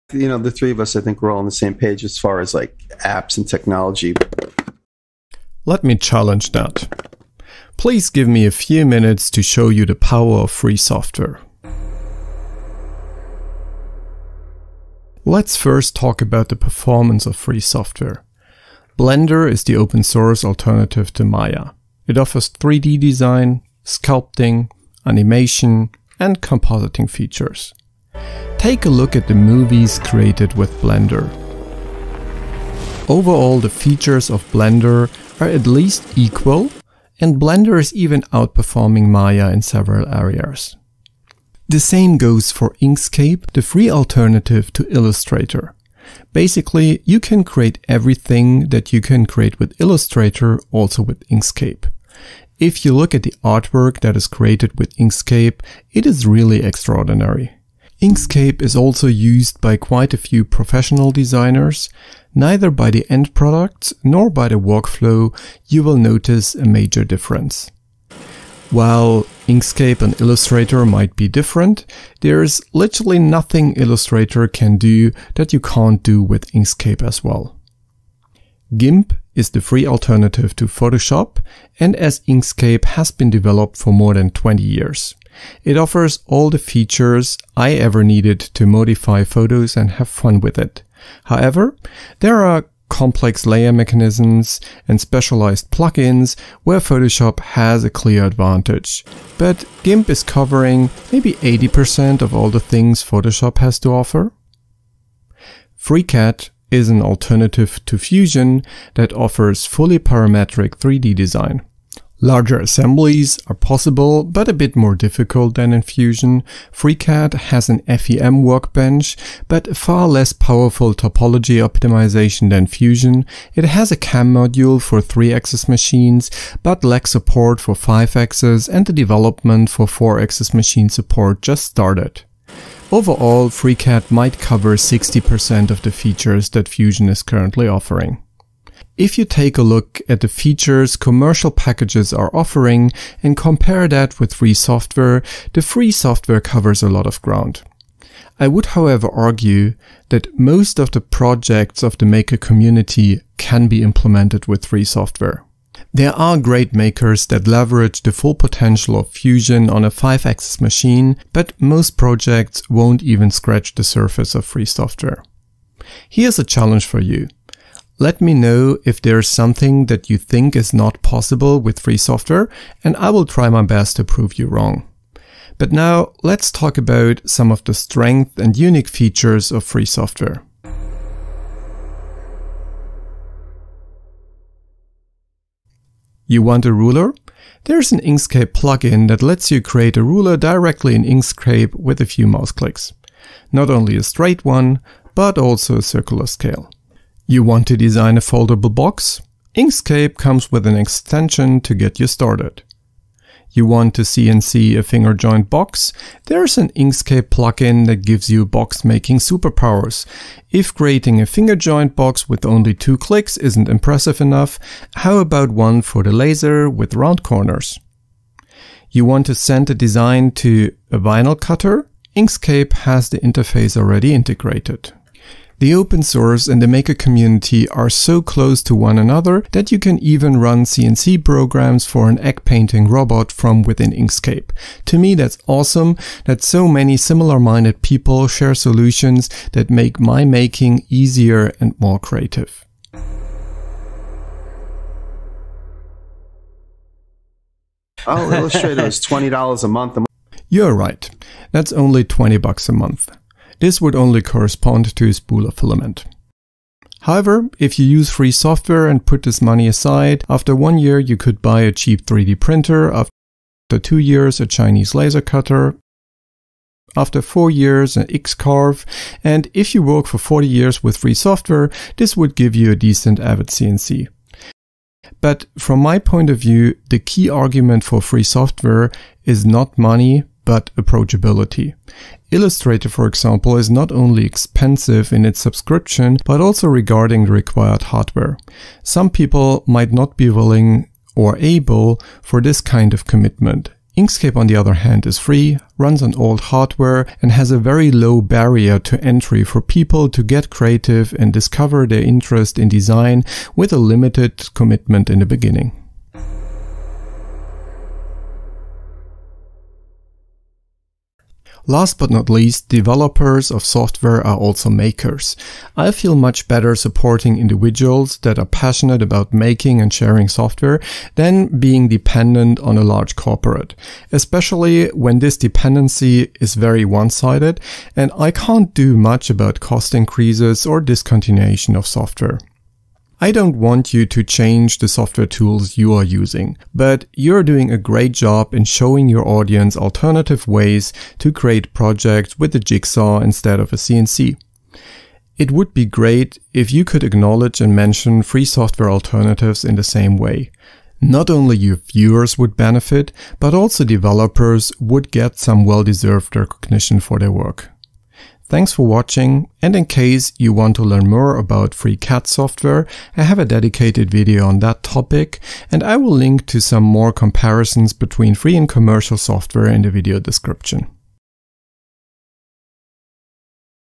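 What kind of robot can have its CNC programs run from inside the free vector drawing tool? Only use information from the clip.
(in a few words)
egg painting robot.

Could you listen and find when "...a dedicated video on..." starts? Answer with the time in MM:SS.
06:03.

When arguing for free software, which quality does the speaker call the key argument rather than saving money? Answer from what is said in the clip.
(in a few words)
approachability.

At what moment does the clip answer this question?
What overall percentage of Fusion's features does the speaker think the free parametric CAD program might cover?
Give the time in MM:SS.
02:14.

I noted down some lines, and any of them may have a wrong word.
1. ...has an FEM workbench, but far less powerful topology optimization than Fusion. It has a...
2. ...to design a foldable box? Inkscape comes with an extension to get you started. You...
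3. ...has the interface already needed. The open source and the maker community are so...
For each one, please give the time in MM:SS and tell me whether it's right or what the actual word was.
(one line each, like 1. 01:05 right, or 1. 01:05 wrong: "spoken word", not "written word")
1. 01:57 right
2. 03:17 right
3. 03:42 wrong: "integrated", not "needed".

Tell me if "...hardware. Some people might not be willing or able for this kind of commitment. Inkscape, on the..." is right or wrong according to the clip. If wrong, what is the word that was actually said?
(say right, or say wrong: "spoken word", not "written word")
right.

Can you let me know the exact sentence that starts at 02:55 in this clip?
But now let's talk about some of the strength and unique features of free software.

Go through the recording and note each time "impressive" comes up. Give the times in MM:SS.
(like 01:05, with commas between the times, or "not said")
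03:33.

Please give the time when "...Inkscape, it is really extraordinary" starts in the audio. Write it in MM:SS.
00:54.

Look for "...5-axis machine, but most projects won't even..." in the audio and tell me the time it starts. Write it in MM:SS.
02:39.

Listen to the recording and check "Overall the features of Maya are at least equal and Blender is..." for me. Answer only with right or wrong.
wrong.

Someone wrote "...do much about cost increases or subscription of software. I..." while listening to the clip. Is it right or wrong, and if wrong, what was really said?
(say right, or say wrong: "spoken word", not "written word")
wrong: "discontinuation", not "subscription".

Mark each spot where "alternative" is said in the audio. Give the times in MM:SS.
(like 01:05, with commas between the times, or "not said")
00:20, 00:43, 01:19, 01:47, 05:39, 05:48.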